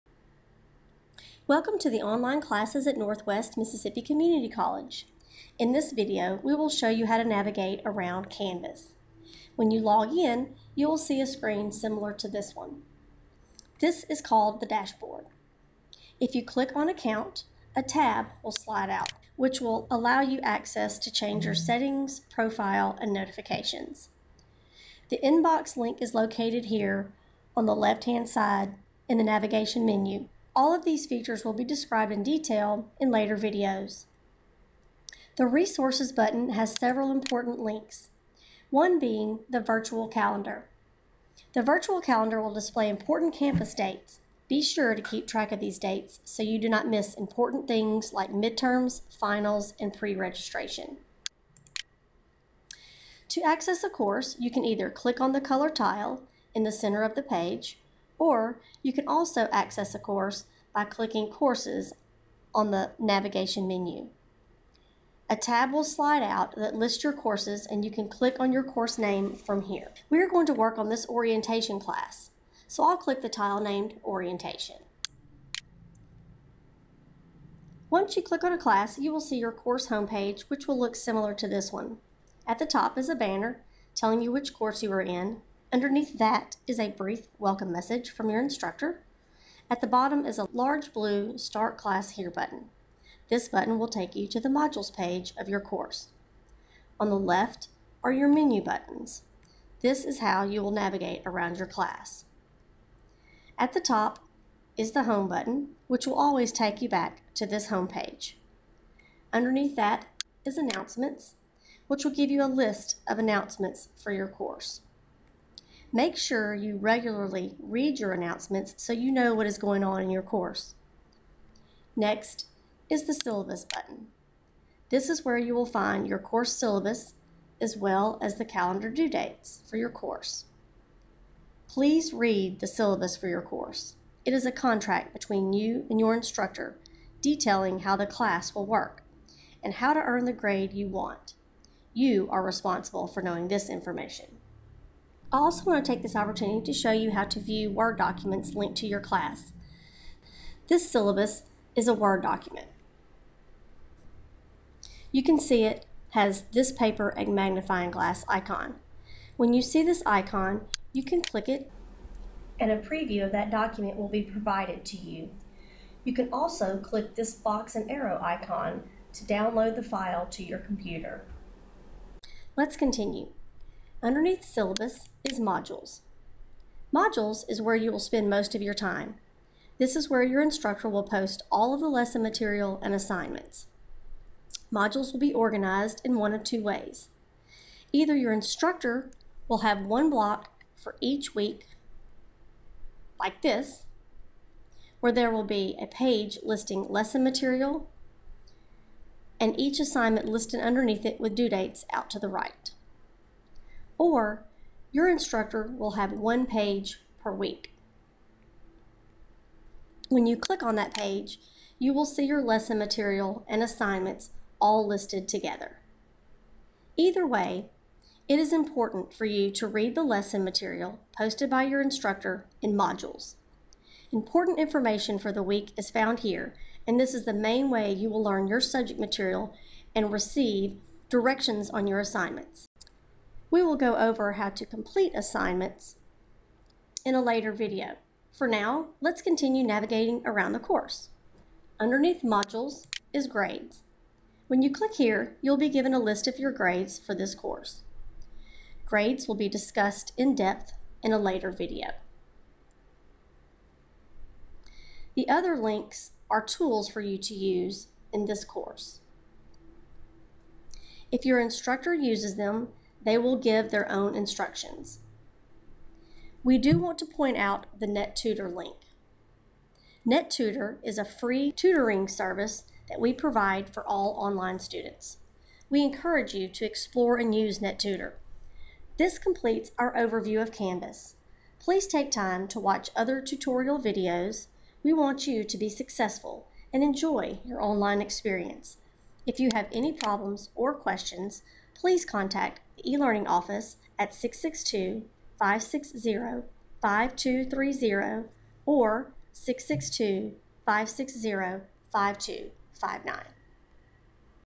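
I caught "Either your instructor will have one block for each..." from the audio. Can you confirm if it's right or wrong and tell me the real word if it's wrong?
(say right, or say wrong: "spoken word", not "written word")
right.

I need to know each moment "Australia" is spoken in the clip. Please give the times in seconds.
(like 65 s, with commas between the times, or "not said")
not said.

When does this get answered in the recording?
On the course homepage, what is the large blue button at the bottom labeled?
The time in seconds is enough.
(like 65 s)
91 s.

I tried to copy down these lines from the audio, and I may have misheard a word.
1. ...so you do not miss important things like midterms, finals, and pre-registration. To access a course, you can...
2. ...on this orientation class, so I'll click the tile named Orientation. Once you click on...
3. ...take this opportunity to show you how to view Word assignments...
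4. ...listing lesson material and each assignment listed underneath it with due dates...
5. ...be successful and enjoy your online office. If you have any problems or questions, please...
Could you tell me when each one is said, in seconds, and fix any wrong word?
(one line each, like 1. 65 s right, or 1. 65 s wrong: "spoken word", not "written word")
1. 46 s right
2. 70 s right
3. 145 s wrong: "documents", not "assignments"
4. 196 s right
5. 285 s wrong: "experience", not "office".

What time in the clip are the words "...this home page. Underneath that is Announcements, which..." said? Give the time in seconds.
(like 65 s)
107 s.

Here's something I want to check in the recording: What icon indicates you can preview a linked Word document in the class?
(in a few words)
Paper and magnifying glass.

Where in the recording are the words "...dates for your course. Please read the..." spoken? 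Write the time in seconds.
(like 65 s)
129 s.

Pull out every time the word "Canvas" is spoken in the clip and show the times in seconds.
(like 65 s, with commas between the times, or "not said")
8 s, 280 s.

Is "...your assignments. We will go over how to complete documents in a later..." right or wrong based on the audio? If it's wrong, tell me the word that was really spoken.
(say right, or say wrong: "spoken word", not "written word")
wrong: "assignments", not "documents".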